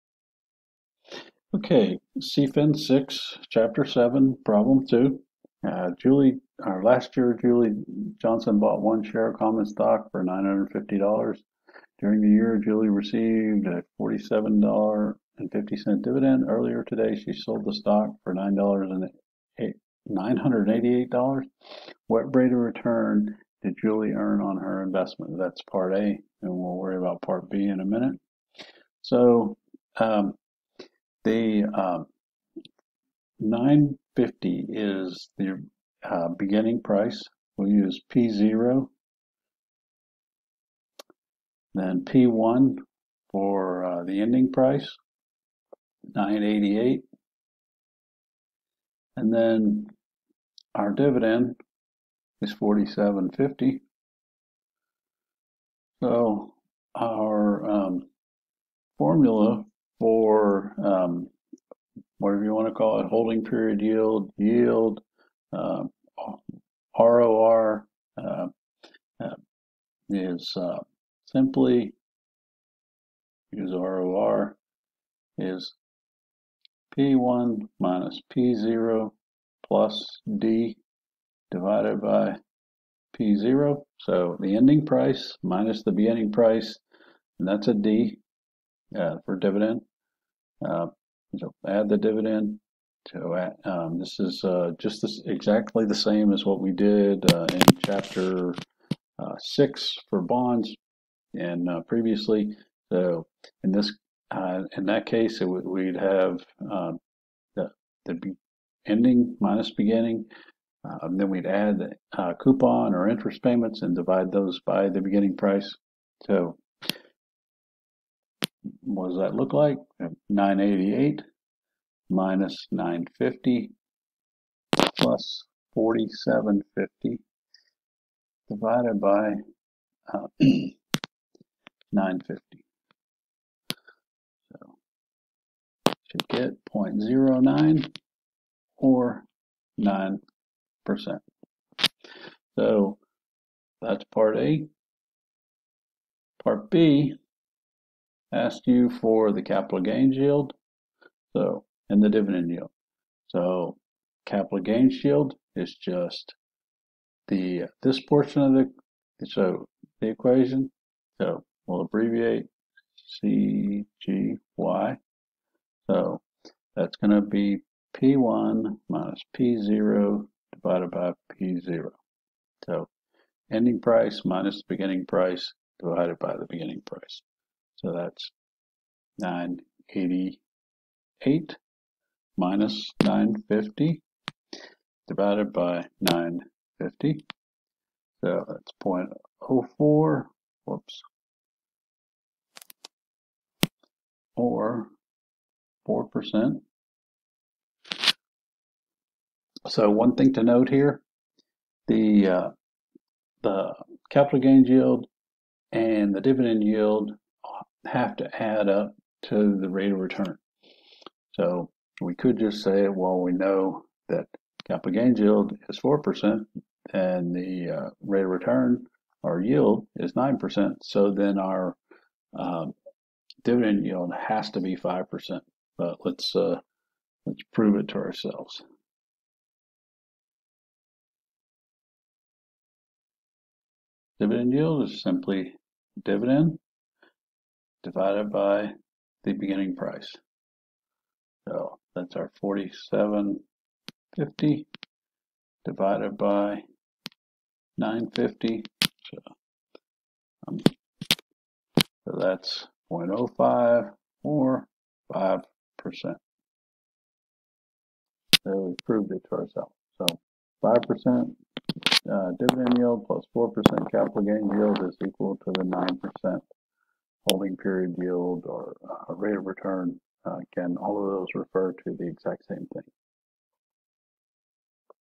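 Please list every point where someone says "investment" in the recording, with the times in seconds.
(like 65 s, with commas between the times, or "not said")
24 s.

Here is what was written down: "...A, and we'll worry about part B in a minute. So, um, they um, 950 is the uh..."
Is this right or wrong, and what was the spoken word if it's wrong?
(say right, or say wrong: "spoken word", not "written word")
right.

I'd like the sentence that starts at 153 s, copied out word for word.
So capital gains yield is just the this portion of the so the equation.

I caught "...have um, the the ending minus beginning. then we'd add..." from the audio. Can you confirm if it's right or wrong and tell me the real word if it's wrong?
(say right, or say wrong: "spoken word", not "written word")
right.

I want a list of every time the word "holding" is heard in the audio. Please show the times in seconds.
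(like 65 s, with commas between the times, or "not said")
63 s.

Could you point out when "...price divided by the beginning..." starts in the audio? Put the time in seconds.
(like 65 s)
175 s.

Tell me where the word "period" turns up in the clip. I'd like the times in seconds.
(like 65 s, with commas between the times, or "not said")
63 s, 267 s.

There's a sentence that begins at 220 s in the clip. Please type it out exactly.
So then our um, dividend yield has to be 5%.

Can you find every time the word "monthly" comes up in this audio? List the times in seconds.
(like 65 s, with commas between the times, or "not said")
not said.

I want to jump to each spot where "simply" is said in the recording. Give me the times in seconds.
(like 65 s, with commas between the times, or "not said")
71 s, 235 s.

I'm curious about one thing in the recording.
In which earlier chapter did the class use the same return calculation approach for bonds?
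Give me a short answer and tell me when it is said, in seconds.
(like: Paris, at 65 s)
Chapter 6, at 99 s.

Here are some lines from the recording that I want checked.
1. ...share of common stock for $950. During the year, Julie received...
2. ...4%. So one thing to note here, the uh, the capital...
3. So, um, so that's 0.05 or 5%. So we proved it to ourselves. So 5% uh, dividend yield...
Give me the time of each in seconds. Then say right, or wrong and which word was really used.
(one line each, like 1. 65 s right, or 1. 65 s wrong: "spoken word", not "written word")
1. 9 s right
2. 195 s right
3. 248 s right.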